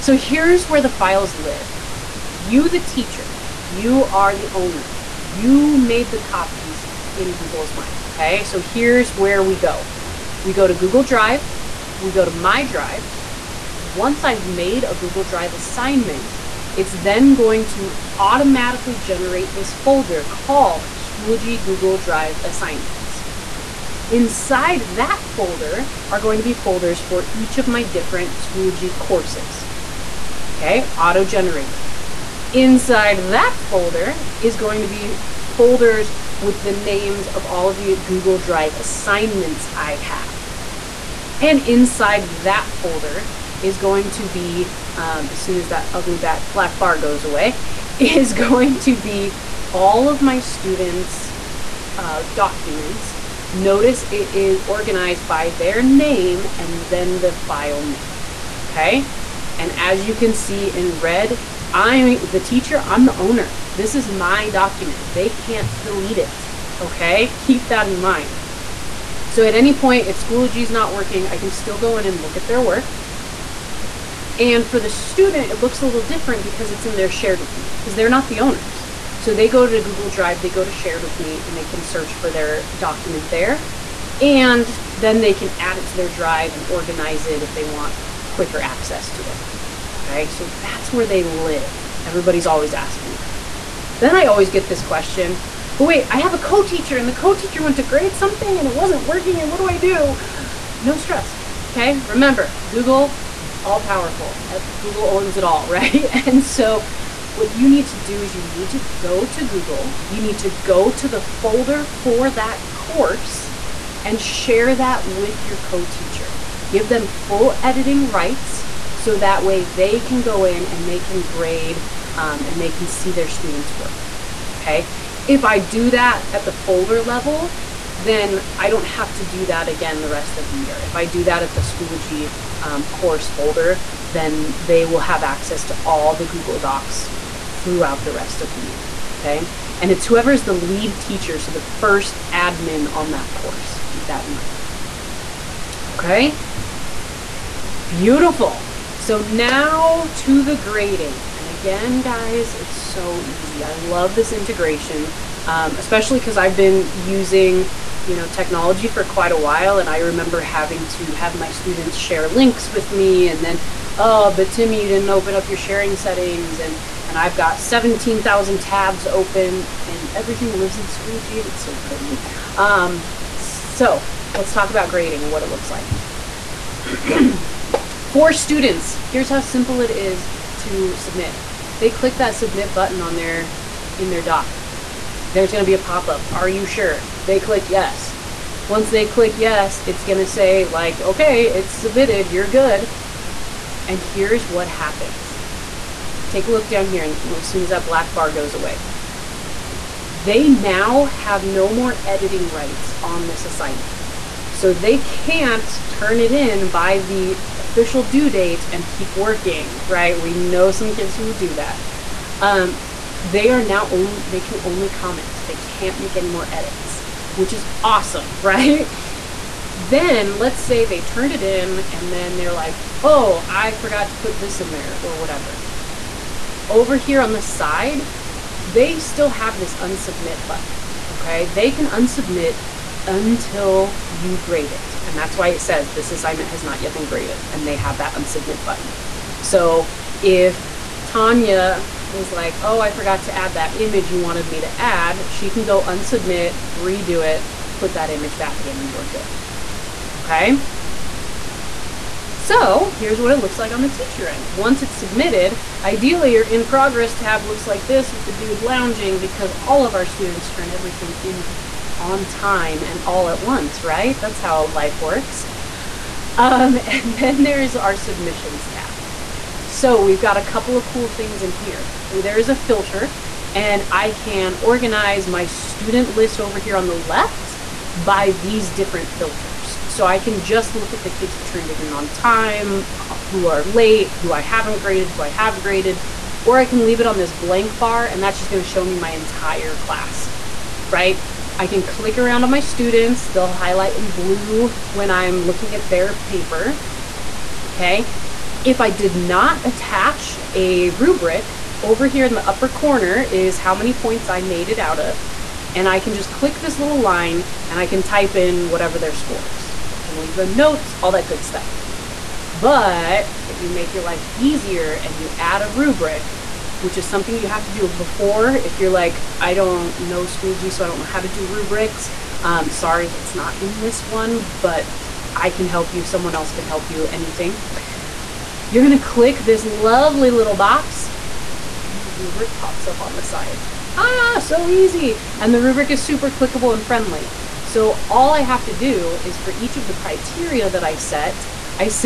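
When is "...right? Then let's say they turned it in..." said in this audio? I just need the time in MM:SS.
03:38.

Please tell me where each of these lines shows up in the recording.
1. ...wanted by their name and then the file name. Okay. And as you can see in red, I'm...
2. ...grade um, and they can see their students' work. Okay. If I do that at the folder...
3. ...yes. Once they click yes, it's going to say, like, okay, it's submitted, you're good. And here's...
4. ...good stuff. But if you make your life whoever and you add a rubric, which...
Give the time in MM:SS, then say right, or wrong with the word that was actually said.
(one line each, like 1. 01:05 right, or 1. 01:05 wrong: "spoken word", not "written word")
1. 00:54 wrong: "organized", not "wanted"
2. 02:01 right
3. 03:07 right
4. 05:11 wrong: "easier", not "whoever".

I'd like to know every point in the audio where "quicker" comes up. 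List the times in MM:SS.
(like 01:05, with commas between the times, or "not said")
01:28.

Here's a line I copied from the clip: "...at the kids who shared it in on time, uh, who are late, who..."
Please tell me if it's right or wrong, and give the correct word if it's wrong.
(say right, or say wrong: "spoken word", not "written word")
wrong: "turned", not "shared".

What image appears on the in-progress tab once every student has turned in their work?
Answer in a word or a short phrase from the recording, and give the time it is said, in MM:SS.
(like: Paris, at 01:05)
The dude lounging, at 04:18.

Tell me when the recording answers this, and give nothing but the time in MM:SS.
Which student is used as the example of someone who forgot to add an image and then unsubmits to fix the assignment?
04:01.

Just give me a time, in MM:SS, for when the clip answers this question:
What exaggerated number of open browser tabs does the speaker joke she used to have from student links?
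02:47.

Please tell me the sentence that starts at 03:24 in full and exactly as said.
So they can't turn it in by the official due date and keep working, right?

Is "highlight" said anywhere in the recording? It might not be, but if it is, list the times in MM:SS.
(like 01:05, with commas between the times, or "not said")
04:53.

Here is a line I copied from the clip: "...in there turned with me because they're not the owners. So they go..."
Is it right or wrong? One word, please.
wrong.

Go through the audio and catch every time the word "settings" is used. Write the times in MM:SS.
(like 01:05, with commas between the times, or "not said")
02:45.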